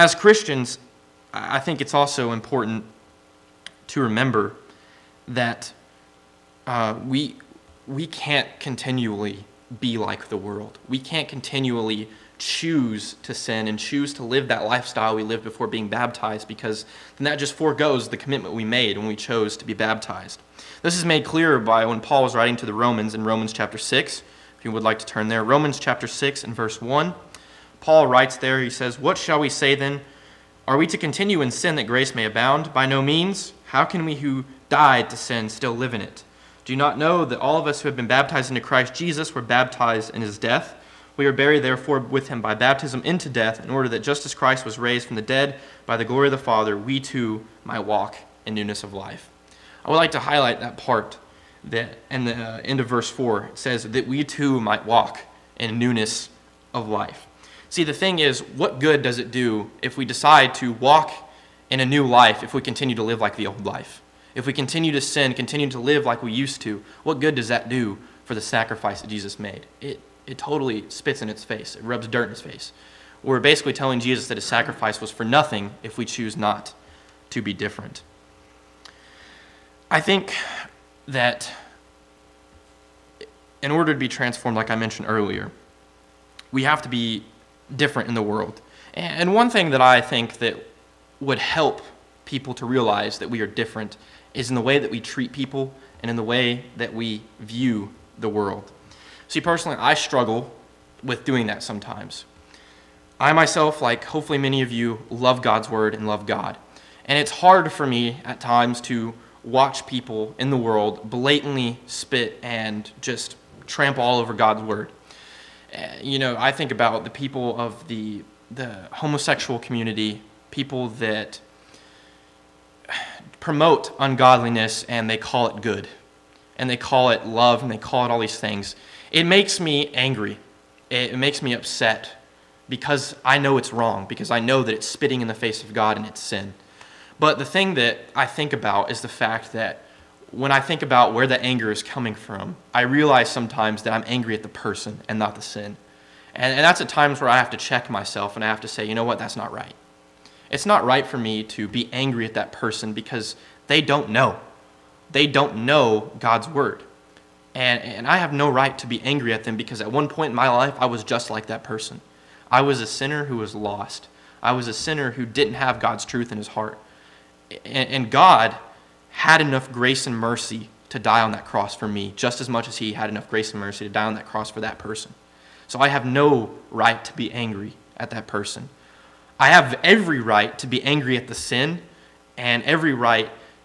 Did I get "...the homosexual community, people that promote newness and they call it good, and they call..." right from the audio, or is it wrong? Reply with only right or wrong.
wrong.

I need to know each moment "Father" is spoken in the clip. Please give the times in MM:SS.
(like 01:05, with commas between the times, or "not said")
00:46.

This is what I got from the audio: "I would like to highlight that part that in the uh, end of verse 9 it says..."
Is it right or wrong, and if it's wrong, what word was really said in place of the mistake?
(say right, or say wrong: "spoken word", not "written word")
wrong: "4", not "9".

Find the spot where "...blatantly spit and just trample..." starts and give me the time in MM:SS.
01:51.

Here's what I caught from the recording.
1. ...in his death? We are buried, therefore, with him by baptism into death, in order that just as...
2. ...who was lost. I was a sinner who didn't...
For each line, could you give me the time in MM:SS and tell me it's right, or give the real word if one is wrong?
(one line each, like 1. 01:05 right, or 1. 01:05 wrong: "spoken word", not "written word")
1. 00:40 right
2. 02:43 right.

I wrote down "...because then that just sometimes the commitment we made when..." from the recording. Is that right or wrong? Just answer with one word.
wrong.